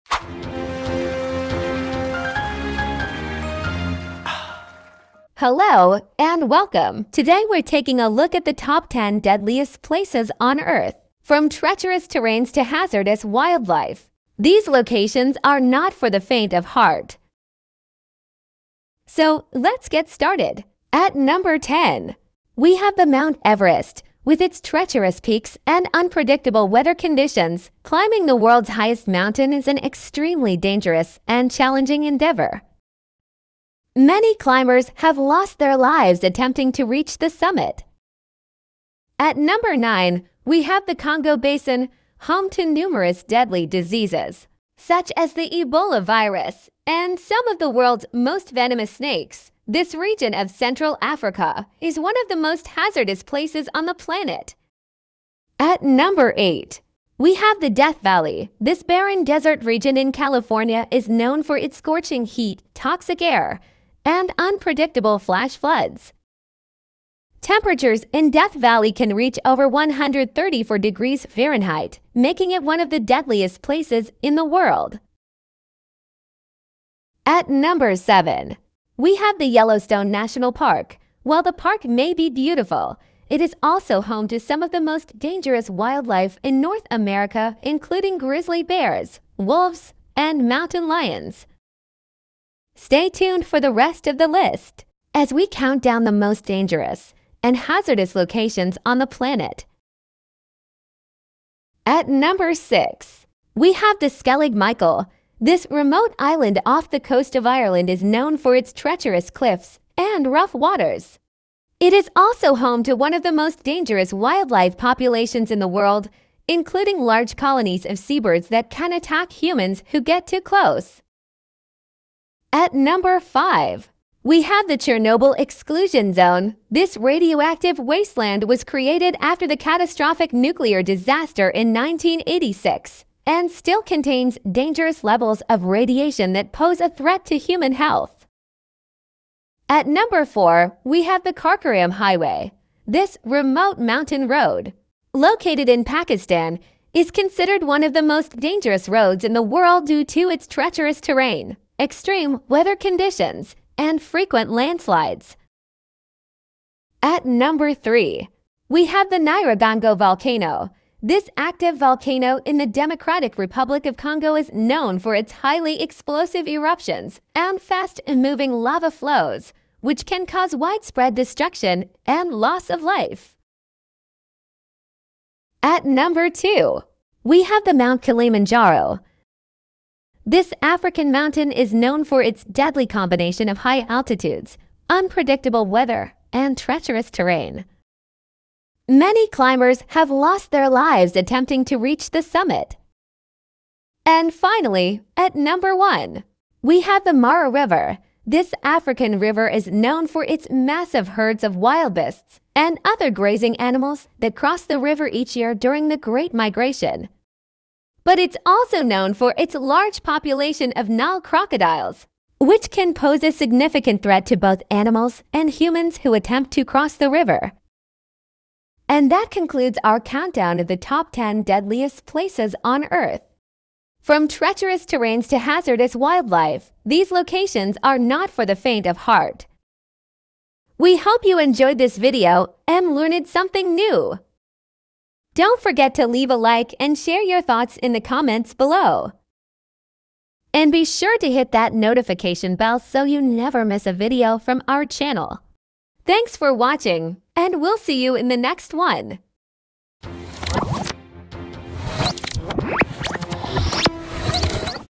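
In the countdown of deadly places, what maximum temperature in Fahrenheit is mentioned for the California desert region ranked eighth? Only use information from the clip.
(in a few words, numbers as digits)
134 degrees.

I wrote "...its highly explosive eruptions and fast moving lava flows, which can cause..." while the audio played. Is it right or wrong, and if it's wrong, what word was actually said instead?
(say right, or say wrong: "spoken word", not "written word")
right.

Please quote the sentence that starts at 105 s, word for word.
This remote island off the coast of Ireland is known for its treacherous cliffs and rough waters.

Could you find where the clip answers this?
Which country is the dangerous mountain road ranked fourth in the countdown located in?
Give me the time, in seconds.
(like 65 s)
145 s.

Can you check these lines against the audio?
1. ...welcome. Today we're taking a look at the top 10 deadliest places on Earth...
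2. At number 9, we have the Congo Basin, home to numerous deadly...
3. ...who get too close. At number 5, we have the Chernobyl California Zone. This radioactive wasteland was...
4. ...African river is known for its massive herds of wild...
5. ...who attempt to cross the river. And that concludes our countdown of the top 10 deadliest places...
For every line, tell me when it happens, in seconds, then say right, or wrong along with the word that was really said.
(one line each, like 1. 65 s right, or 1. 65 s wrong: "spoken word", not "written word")
1. 6 s right
2. 39 s right
3. 119 s wrong: "Exclusion", not "California"
4. 198 s right
5. 215 s right.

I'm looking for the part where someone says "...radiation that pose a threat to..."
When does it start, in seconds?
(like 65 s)
135 s.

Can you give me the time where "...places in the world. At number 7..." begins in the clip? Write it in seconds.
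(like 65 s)
73 s.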